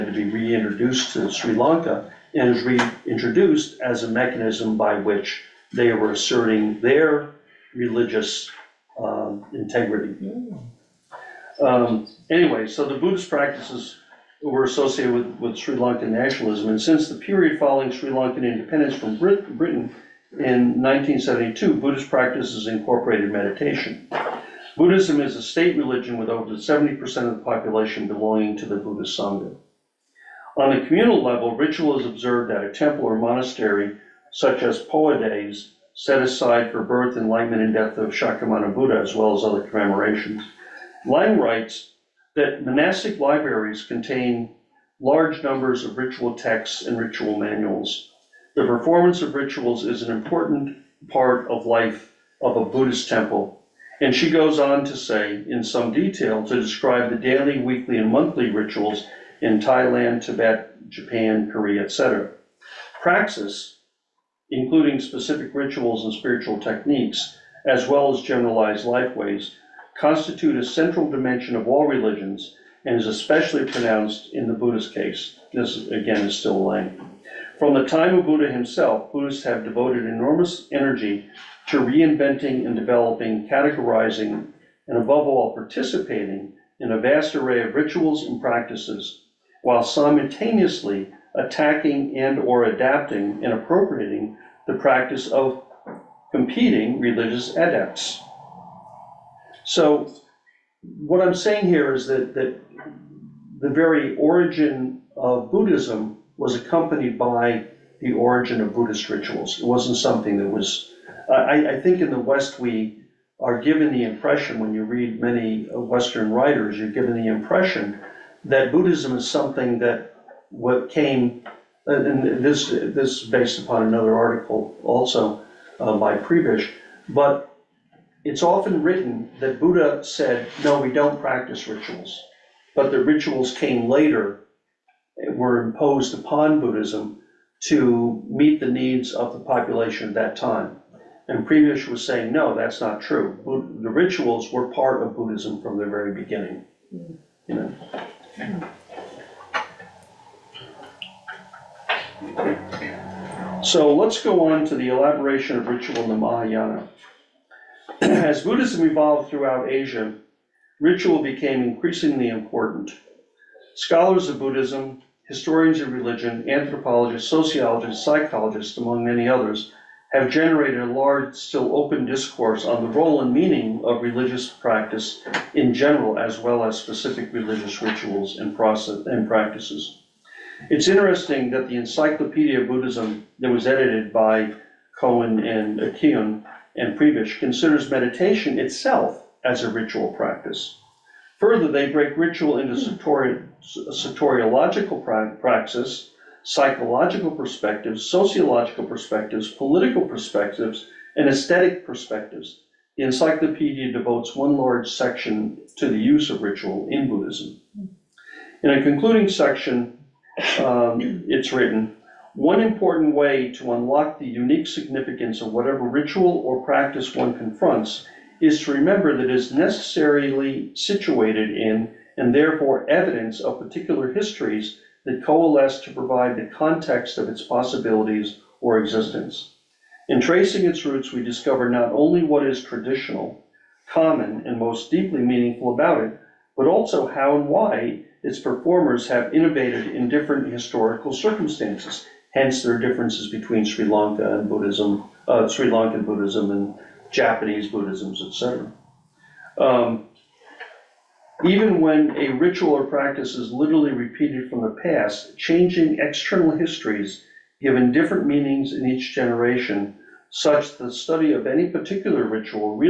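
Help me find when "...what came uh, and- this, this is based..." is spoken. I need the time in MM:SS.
02:00.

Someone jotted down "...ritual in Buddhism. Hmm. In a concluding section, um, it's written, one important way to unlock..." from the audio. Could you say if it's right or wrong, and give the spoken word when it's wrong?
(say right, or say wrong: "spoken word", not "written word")
right.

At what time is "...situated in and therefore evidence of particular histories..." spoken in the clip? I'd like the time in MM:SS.
03:40.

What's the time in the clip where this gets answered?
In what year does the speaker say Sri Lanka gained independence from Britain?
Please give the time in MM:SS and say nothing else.
00:20.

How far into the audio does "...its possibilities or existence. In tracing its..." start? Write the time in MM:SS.
03:47.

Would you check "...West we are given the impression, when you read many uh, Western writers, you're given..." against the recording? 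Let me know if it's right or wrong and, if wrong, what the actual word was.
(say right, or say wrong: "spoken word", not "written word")
right.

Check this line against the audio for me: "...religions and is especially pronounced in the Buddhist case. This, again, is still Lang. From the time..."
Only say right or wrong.
right.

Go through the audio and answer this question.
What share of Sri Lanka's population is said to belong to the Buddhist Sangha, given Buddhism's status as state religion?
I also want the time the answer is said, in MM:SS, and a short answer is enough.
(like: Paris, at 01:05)
over 70%, at 00:26.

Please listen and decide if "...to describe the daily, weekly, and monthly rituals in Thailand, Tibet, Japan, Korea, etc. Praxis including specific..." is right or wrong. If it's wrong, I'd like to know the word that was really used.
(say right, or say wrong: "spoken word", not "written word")
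right.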